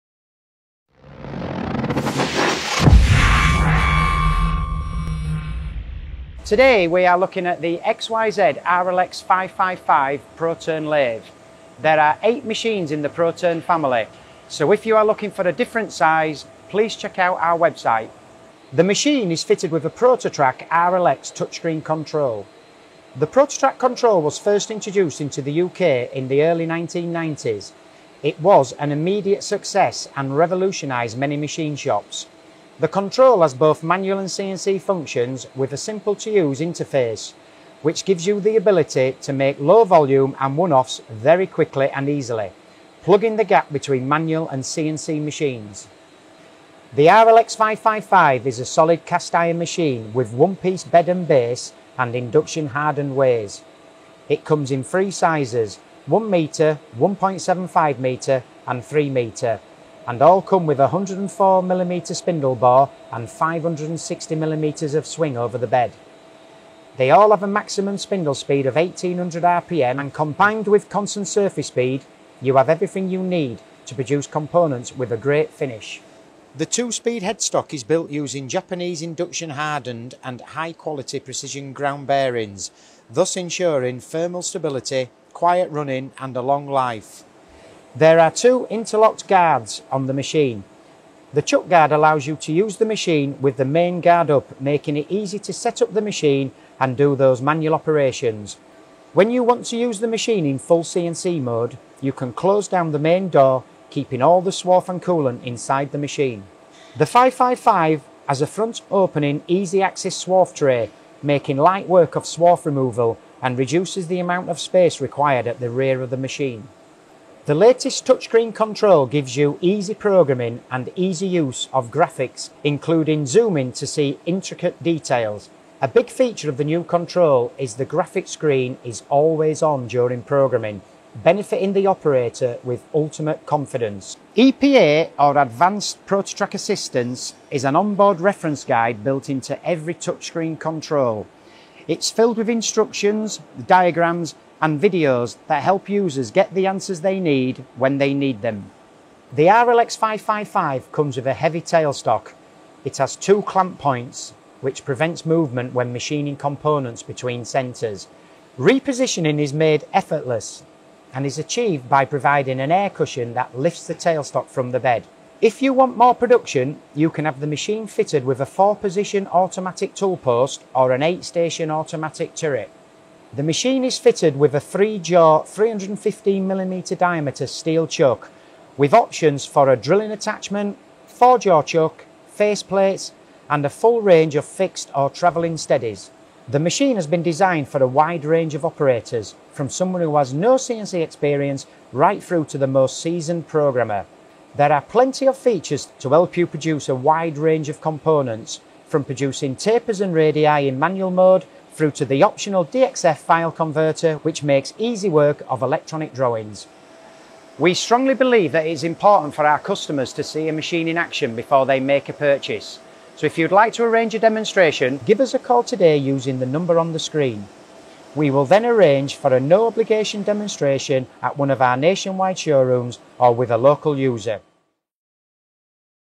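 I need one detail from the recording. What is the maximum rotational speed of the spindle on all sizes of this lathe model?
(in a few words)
1800 RPM.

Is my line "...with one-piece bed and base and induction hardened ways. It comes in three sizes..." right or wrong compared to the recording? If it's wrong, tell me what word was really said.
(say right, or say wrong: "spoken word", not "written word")
right.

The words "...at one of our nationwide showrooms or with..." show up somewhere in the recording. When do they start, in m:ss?
3:41.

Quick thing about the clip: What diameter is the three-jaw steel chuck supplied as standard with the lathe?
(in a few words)
315mm.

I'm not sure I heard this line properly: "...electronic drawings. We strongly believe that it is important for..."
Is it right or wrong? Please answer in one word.
right.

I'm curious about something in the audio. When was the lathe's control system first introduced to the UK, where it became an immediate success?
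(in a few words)
early 1990s.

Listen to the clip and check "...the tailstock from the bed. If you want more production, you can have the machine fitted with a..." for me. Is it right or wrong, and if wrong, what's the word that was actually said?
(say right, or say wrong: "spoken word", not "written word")
right.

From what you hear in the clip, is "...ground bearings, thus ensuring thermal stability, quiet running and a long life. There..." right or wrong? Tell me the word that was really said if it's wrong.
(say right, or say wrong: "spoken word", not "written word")
right.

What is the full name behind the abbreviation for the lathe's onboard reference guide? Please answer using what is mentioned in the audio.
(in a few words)
Advanced ProtoTRAK Assistance.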